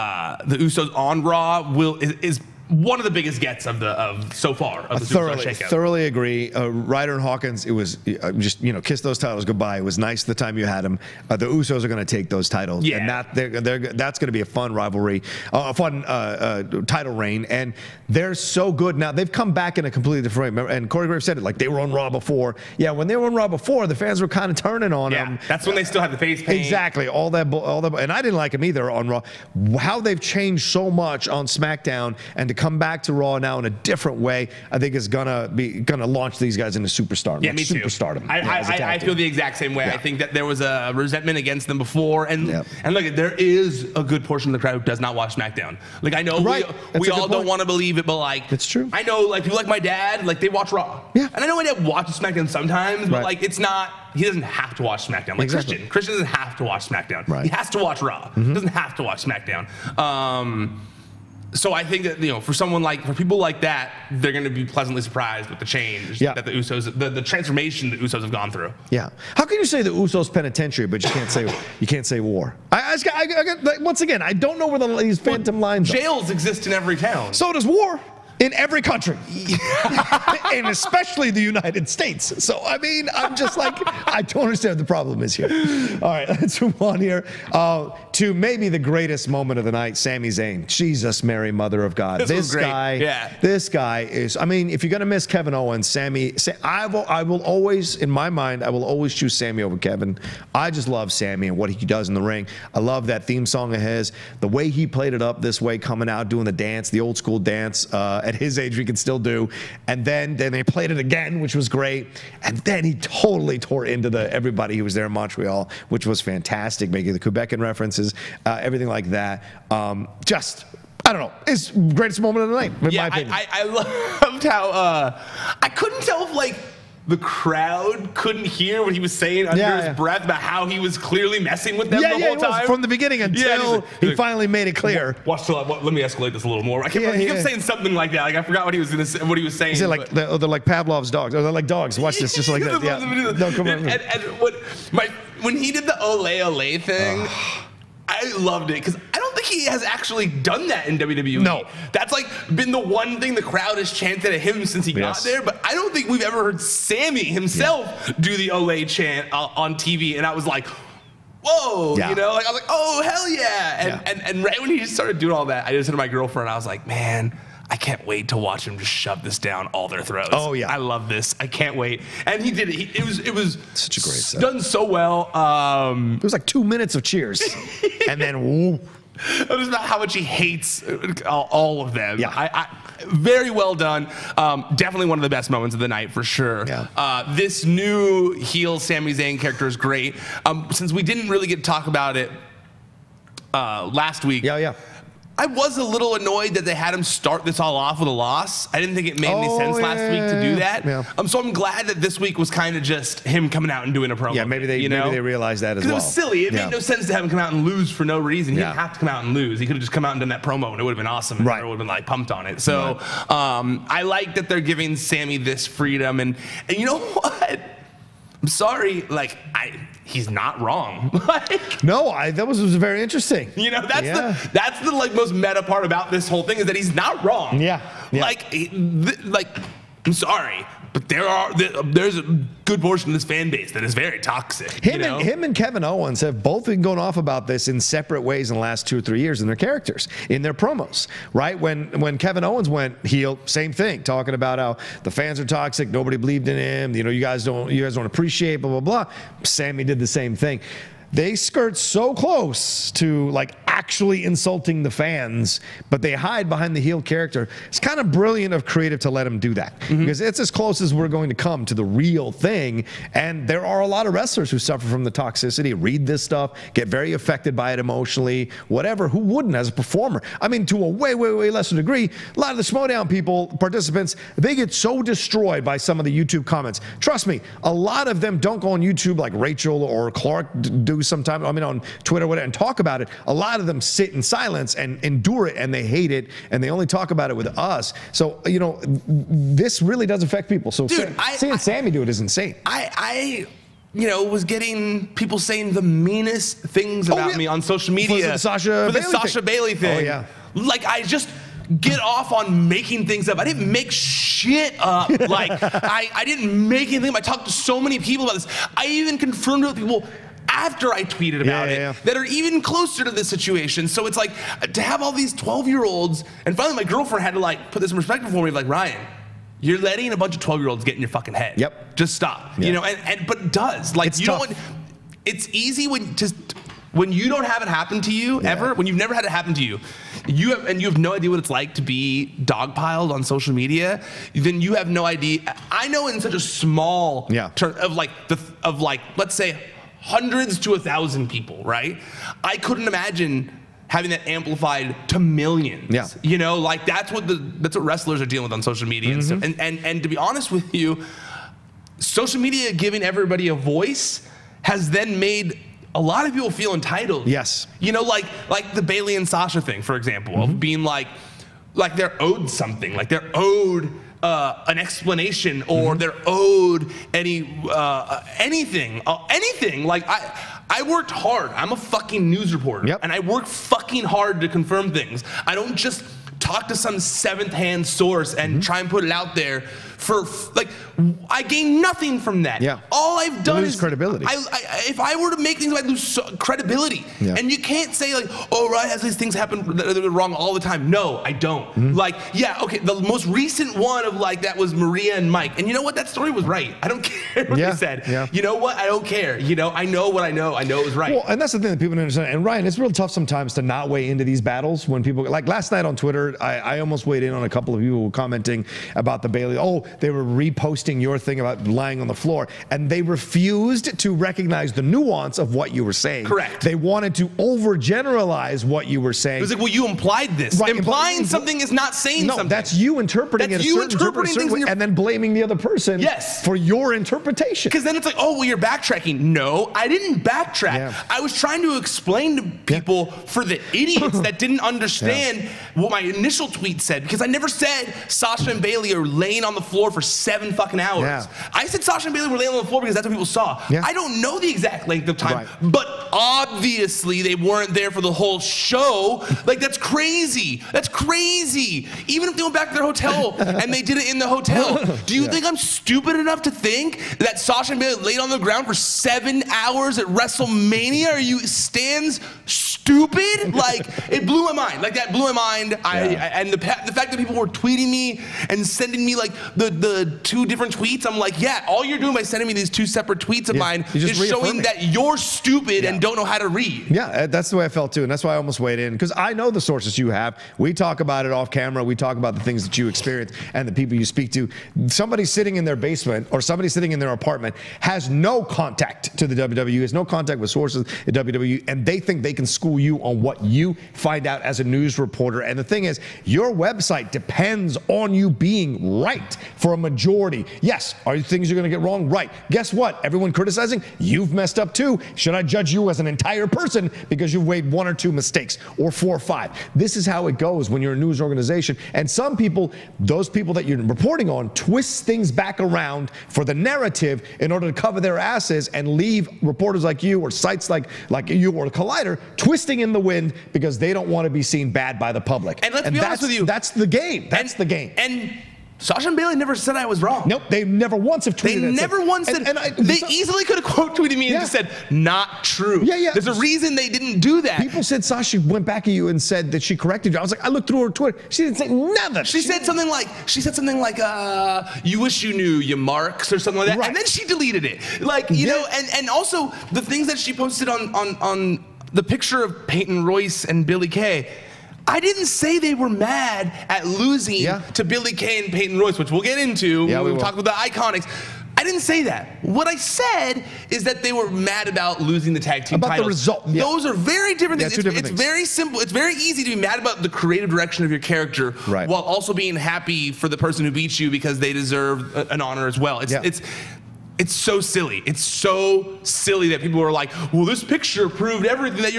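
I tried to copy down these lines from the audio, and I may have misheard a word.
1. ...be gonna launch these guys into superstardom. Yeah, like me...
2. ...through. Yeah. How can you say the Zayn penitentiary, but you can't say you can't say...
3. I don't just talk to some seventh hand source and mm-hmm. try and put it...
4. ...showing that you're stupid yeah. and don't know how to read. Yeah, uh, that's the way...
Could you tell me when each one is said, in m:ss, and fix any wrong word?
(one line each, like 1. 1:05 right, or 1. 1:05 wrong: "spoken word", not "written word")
1. 0:35 right
2. 1:08 wrong: "Usos", not "Zayn"
3. 6:15 right
4. 7:54 right.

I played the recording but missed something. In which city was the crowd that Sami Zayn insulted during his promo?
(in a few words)
Montreal.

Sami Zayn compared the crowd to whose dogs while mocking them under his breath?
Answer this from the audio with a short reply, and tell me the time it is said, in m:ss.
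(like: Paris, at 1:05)
Pavlov, at 2:20.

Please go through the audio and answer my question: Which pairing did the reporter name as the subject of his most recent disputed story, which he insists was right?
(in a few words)
Maria and Mike.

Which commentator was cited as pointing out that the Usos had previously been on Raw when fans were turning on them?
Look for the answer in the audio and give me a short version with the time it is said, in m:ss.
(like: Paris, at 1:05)
Corey Graves, at 0:20.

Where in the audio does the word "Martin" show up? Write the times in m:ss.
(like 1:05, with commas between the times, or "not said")
not said.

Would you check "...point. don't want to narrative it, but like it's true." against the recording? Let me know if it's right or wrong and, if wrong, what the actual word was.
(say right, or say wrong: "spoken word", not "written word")
wrong: "believe", not "narrative".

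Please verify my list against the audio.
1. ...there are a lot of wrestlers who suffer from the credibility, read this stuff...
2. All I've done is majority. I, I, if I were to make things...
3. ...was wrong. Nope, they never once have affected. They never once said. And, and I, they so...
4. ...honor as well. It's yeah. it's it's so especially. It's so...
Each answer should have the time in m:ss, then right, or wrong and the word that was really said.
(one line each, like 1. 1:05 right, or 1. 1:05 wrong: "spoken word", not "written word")
1. 4:23 wrong: "toxicity", not "credibility"
2. 6:22 wrong: "credibility", not "majority"
3. 8:49 wrong: "tweeted", not "affected"
4. 9:35 wrong: "silly", not "especially".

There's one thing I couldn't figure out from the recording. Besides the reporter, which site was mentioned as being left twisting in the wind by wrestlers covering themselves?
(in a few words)
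Collider.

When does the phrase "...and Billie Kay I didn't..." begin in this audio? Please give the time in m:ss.
9:13.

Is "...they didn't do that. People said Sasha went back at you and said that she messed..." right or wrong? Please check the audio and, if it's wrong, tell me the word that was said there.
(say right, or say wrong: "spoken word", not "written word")
wrong: "corrected", not "messed".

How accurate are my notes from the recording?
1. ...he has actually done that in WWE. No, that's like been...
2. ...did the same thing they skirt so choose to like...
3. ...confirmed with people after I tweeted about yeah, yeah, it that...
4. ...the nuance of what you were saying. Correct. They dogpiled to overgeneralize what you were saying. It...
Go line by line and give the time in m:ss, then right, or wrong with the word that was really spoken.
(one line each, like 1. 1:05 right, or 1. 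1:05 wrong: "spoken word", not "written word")
1. 2:29 right
2. 4:09 wrong: "close", not "choose"
3. 5:09 right
4. 6:54 wrong: "wanted", not "dogpiled".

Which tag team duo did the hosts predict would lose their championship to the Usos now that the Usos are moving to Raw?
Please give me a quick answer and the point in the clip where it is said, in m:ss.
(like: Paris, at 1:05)
Ryder and Hawkins, at 0:06.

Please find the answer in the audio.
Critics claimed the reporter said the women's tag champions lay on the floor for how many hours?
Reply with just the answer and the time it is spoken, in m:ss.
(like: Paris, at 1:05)
7, at 7:20.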